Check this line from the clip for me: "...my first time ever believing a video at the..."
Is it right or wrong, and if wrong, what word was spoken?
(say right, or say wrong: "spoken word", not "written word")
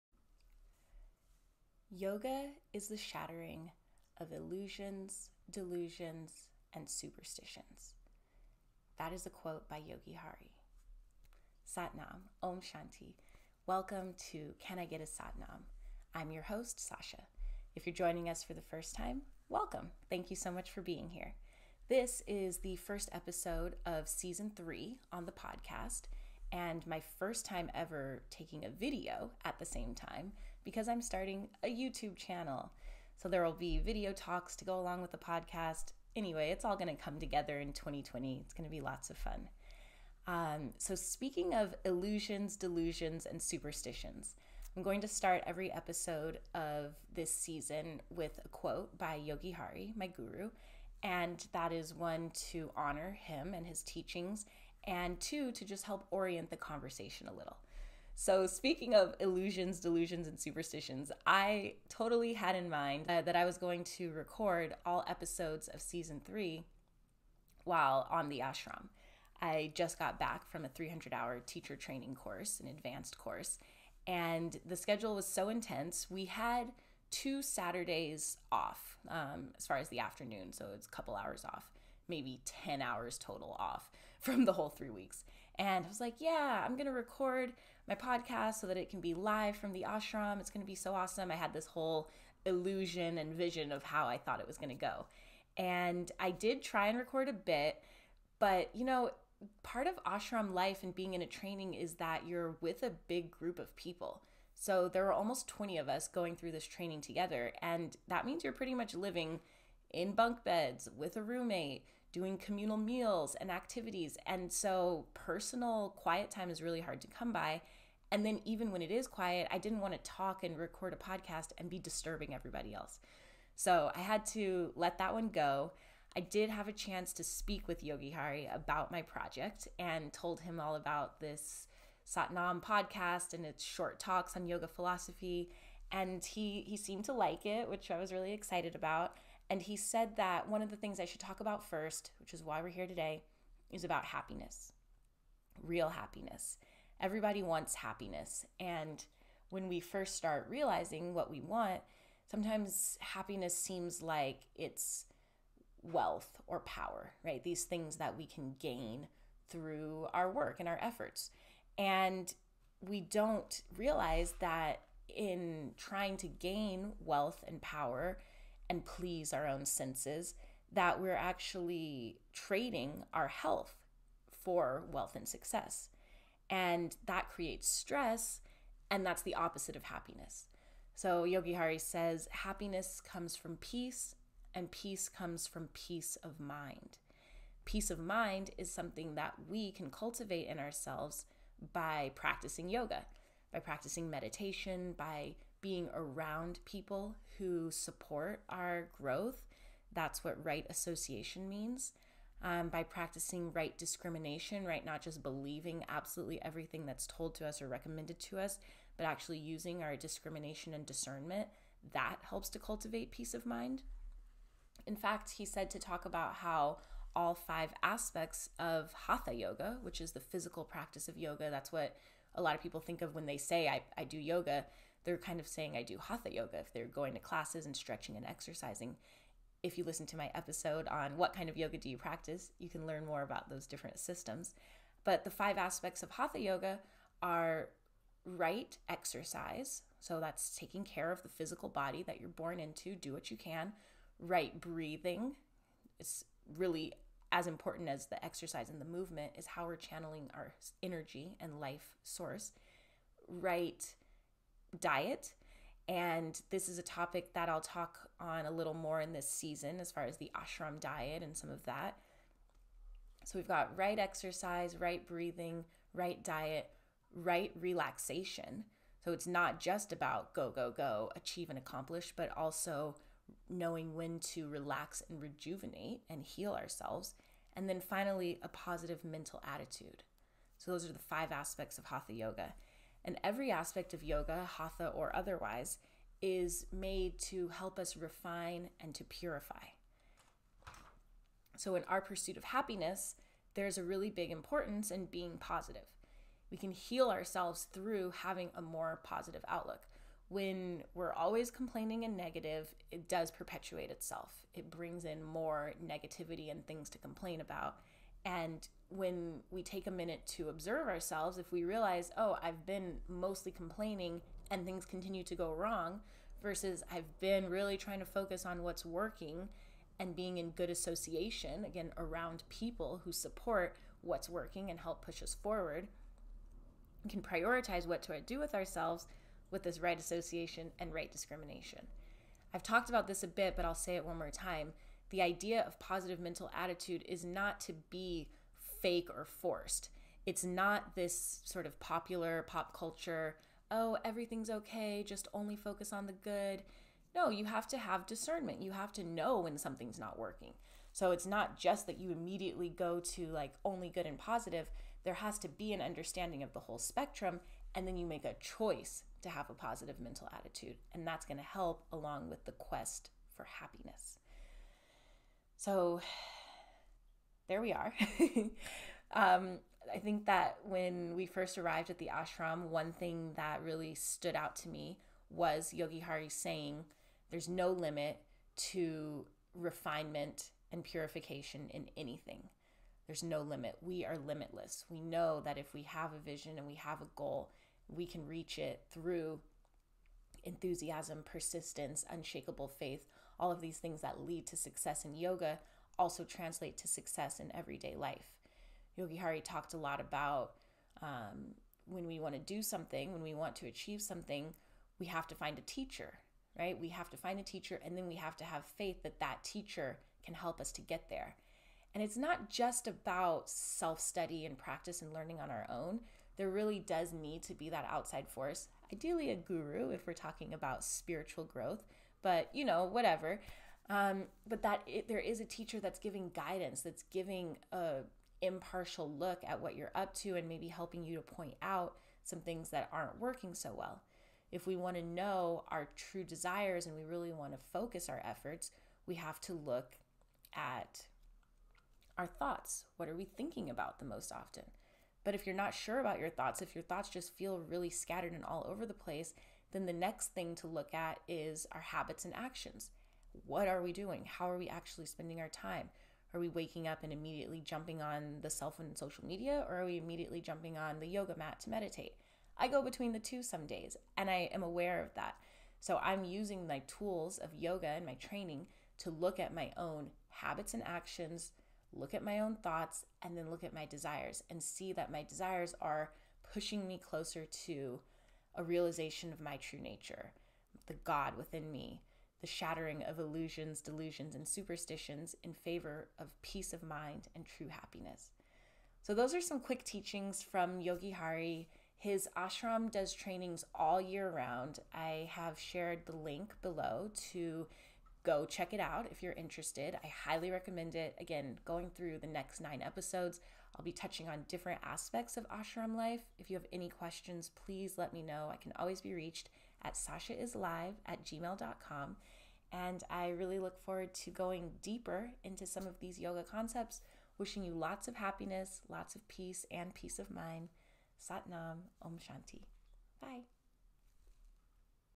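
wrong: "taking", not "believing".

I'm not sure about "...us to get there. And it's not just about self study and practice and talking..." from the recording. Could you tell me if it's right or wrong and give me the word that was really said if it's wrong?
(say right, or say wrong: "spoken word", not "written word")
wrong: "learning", not "talking".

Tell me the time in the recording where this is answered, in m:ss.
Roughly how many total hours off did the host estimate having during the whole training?
1:22.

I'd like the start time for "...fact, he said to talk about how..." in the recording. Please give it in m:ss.
3:34.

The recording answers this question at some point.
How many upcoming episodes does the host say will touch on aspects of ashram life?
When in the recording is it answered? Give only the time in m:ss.
8:22.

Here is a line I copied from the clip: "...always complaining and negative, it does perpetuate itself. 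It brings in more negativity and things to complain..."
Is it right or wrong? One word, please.
right.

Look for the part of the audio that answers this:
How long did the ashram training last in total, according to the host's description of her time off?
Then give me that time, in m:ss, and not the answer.
1:24.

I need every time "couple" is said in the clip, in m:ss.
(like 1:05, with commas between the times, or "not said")
1:20.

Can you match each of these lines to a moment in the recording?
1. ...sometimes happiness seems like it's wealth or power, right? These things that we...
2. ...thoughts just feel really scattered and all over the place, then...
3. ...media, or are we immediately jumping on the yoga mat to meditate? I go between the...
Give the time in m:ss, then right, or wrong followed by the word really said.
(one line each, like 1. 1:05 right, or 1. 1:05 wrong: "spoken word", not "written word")
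1. 2:32 right
2. 7:26 right
3. 7:39 right.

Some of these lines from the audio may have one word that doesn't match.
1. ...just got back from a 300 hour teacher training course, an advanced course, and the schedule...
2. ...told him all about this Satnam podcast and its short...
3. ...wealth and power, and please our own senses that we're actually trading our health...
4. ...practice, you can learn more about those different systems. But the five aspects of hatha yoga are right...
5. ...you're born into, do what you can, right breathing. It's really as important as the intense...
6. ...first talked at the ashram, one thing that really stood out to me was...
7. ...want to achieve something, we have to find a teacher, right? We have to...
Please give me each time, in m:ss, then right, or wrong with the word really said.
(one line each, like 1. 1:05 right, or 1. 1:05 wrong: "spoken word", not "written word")
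1. 1:09 right
2. 2:10 right
3. 2:47 right
4. 3:51 right
5. 4:02 wrong: "exercise", not "intense"
6. 6:11 wrong: "arrived", not "talked"
7. 6:43 right.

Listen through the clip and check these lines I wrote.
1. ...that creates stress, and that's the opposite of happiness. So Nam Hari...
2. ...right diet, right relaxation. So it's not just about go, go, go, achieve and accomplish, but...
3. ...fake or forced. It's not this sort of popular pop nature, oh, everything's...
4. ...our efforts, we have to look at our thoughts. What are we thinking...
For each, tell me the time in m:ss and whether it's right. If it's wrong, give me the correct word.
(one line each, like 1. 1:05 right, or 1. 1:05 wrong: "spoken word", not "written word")
1. 2:57 wrong: "Yogi", not "Nam"
2. 4:25 right
3. 5:38 wrong: "culture", not "nature"
4. 7:18 right.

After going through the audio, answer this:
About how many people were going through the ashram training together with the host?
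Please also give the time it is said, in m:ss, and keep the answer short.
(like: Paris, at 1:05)
20, at 1:45.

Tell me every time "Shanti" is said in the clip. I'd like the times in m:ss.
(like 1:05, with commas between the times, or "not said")
0:12, 8:42.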